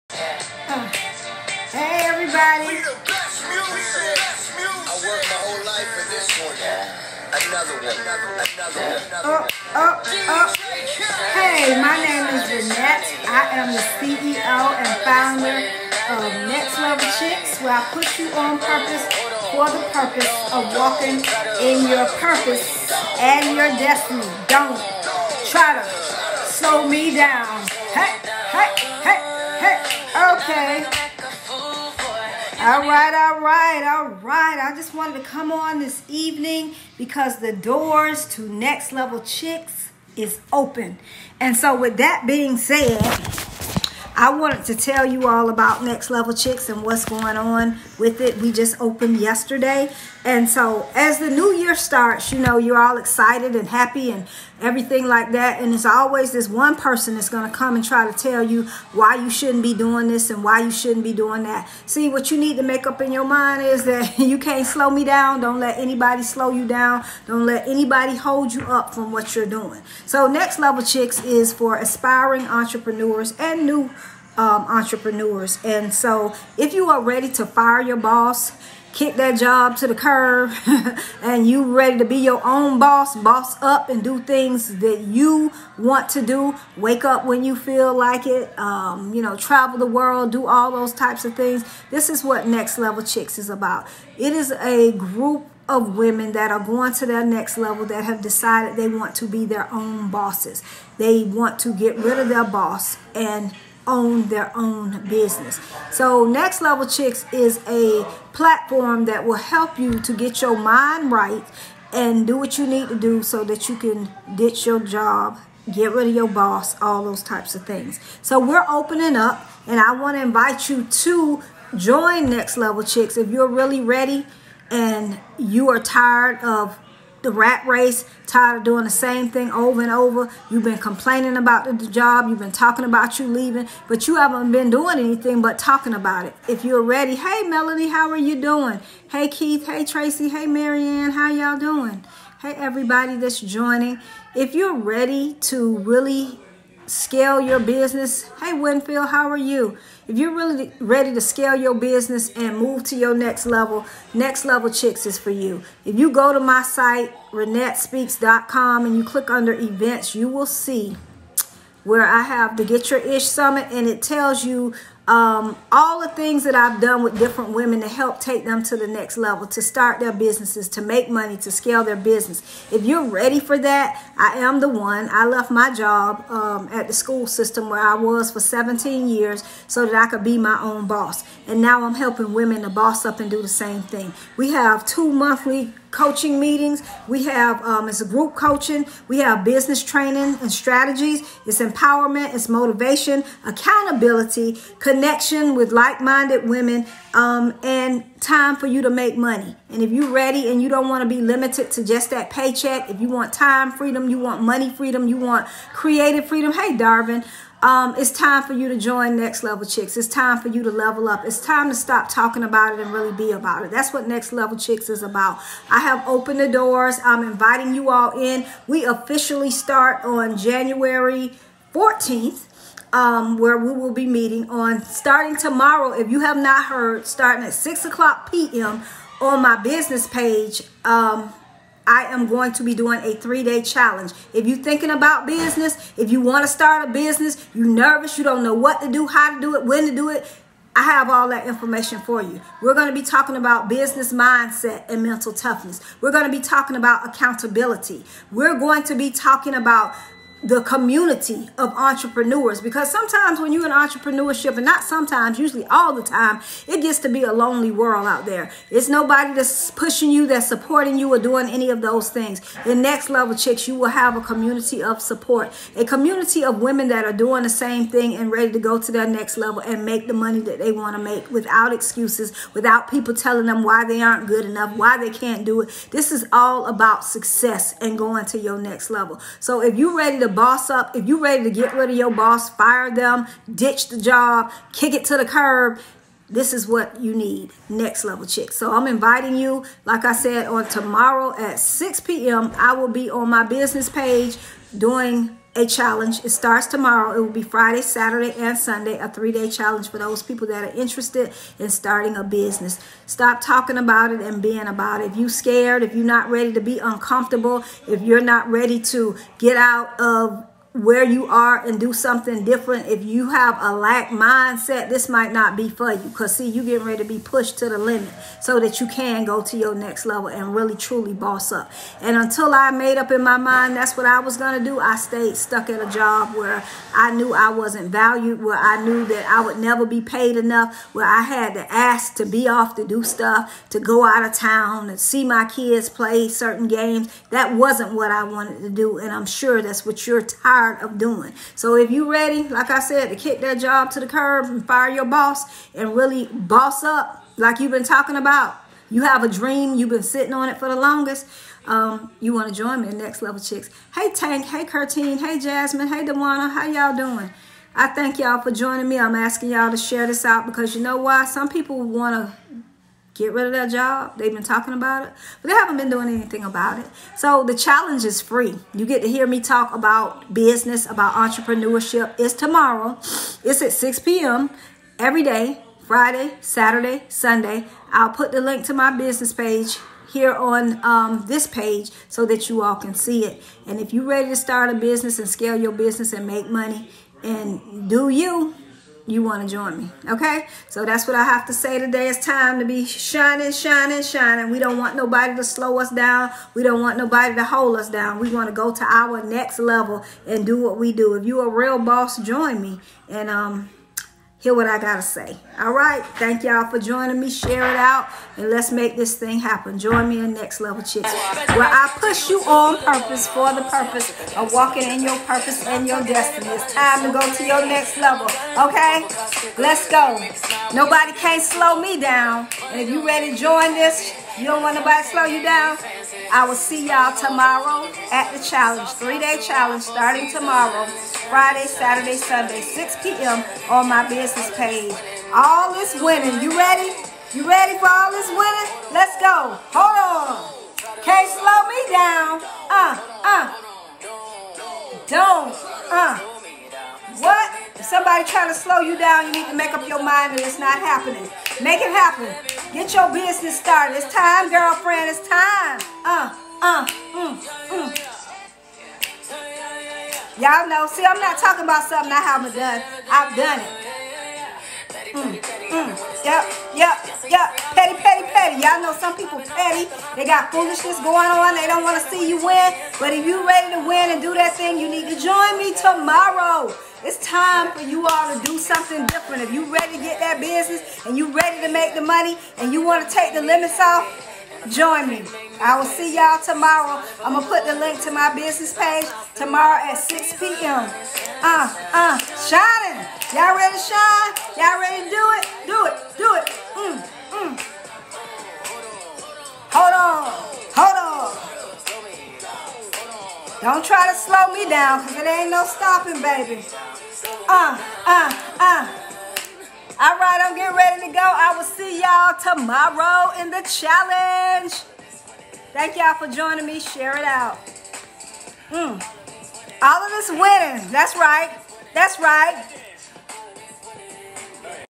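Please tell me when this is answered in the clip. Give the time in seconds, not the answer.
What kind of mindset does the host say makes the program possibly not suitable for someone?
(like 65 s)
313 s.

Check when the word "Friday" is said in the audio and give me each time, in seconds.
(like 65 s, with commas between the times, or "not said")
297 s, 375 s, 431 s.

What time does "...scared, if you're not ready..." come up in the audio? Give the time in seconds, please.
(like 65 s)
305 s.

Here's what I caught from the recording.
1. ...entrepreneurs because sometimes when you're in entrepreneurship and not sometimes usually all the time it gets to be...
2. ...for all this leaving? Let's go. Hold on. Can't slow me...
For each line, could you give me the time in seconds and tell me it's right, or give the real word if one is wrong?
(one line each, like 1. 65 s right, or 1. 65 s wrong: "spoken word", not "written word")
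1. 251 s right
2. 437 s wrong: "winning", not "leaving".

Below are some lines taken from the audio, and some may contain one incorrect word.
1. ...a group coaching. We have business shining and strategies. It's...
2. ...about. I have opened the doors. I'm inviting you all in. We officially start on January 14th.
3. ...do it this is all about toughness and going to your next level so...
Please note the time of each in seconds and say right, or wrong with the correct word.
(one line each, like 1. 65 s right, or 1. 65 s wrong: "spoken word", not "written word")
1. 188 s wrong: "training", not "shining"
2. 215 s right
3. 275 s wrong: "success", not "toughness".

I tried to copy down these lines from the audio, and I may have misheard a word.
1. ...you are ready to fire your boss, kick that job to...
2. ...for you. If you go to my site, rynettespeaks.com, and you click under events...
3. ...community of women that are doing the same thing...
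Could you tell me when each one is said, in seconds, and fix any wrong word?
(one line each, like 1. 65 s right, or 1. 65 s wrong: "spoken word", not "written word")
1. 76 s right
2. 155 s right
3. 265 s right.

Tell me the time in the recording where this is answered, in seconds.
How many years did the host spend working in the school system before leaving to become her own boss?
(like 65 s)
178 s.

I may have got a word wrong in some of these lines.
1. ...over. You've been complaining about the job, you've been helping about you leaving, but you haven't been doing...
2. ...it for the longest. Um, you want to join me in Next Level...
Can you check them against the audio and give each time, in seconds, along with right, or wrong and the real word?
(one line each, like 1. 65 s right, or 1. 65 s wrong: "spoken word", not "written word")
1. 129 s wrong: "talking", not "helping"
2. 350 s right.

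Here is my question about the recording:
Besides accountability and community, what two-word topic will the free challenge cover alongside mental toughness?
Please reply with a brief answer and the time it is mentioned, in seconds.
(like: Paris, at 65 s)
Business mindset, at 243 s.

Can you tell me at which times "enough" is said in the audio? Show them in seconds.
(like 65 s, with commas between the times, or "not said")
274 s, 330 s.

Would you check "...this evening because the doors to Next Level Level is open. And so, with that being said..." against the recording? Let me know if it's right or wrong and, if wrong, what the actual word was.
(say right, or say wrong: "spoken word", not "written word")
wrong: "Chicks", not "Level".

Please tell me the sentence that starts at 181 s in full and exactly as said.
And now I'm helping women to boss up and do the same thing.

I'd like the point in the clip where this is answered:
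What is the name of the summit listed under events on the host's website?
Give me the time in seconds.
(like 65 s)
162 s.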